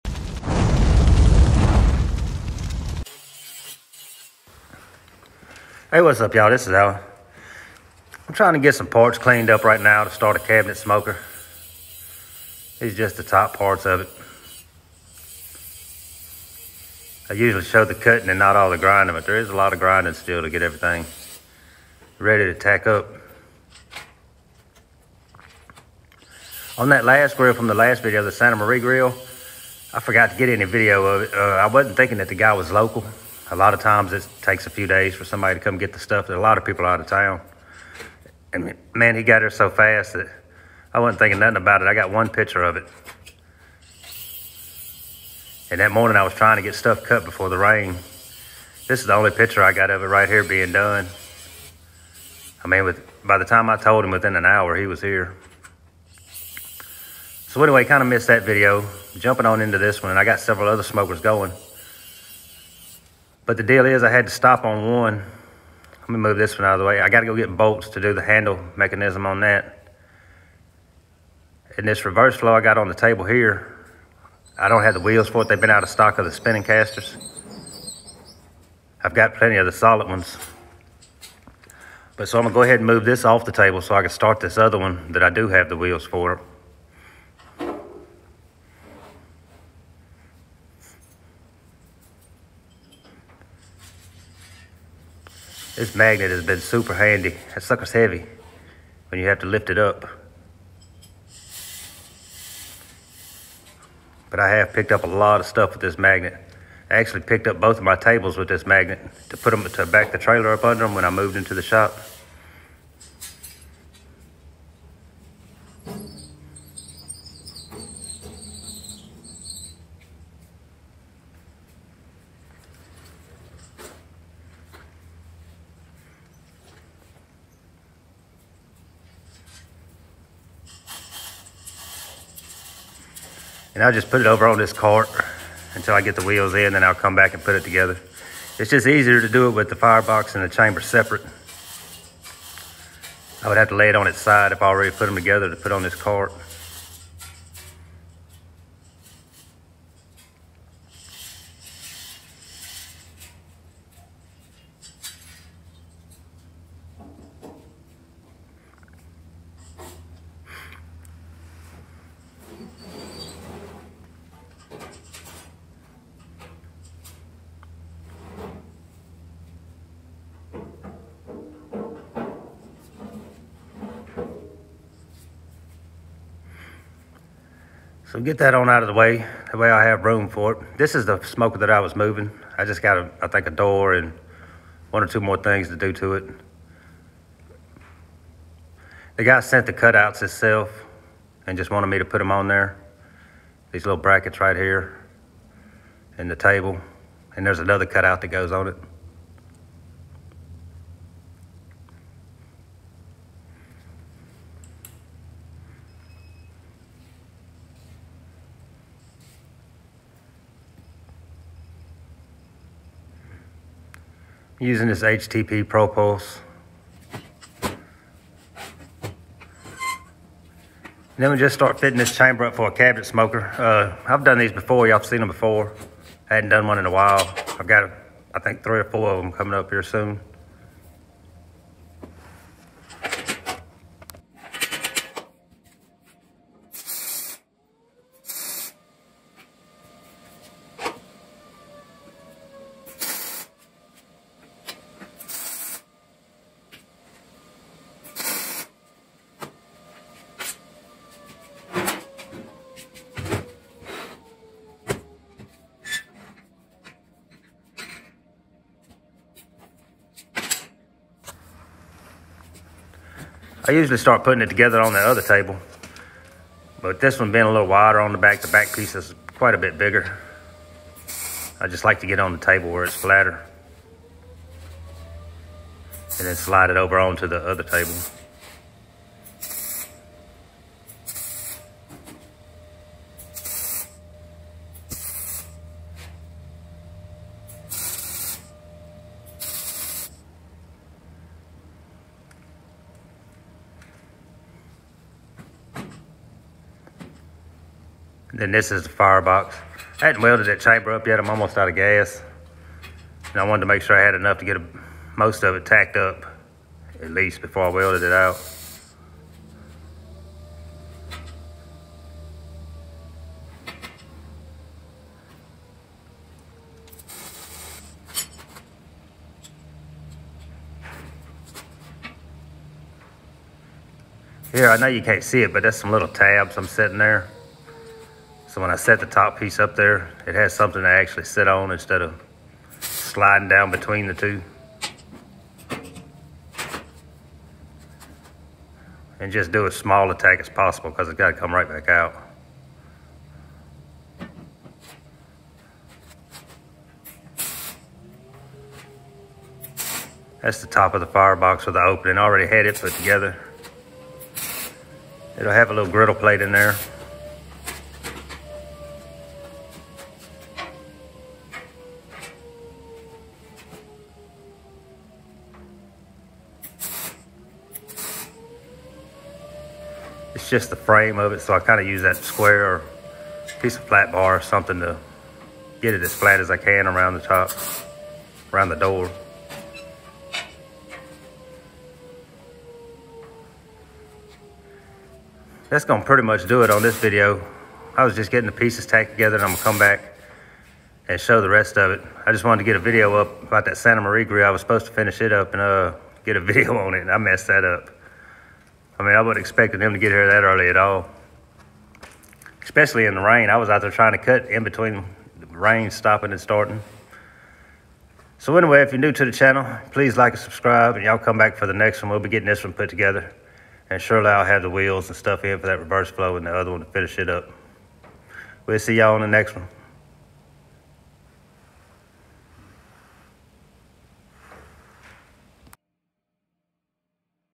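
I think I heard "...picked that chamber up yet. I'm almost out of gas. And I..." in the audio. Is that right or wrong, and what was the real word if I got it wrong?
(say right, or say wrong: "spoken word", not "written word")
wrong: "welded", not "picked".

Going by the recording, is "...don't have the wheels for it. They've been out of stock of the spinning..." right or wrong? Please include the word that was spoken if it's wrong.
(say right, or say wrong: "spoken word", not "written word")
right.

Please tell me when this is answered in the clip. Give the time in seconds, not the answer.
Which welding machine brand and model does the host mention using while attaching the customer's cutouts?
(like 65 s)
215 s.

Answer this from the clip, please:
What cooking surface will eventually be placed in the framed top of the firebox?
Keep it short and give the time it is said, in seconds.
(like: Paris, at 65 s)
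Griddle plate, at 355 s.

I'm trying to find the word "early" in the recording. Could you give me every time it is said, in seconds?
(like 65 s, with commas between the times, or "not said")
400 s.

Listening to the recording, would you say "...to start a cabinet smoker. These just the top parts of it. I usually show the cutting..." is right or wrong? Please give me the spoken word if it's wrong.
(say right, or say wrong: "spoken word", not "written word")
right.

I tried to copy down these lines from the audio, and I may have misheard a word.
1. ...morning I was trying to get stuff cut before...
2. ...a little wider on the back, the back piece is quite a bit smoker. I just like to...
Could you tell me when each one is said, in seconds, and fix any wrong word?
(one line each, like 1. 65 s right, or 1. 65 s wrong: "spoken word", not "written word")
1. 45 s right
2. 267 s wrong: "bigger", not "smoker".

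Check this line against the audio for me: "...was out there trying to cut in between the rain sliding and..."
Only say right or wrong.
wrong.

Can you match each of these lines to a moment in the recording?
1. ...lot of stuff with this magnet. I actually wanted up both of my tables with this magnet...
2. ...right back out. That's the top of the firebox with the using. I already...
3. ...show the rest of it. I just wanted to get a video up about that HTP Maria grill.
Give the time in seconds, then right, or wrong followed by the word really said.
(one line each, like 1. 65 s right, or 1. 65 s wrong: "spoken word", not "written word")
1. 105 s wrong: "picked", not "wanted"
2. 341 s wrong: "opening", not "using"
3. 391 s wrong: "Santa", not "HTP".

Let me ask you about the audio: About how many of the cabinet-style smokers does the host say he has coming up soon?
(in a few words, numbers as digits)
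3 or 4.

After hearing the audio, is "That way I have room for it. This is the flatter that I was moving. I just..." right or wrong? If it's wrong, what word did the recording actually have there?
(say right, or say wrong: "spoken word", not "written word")
wrong: "smoker", not "flatter".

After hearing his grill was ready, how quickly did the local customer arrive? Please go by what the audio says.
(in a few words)
Within an hour.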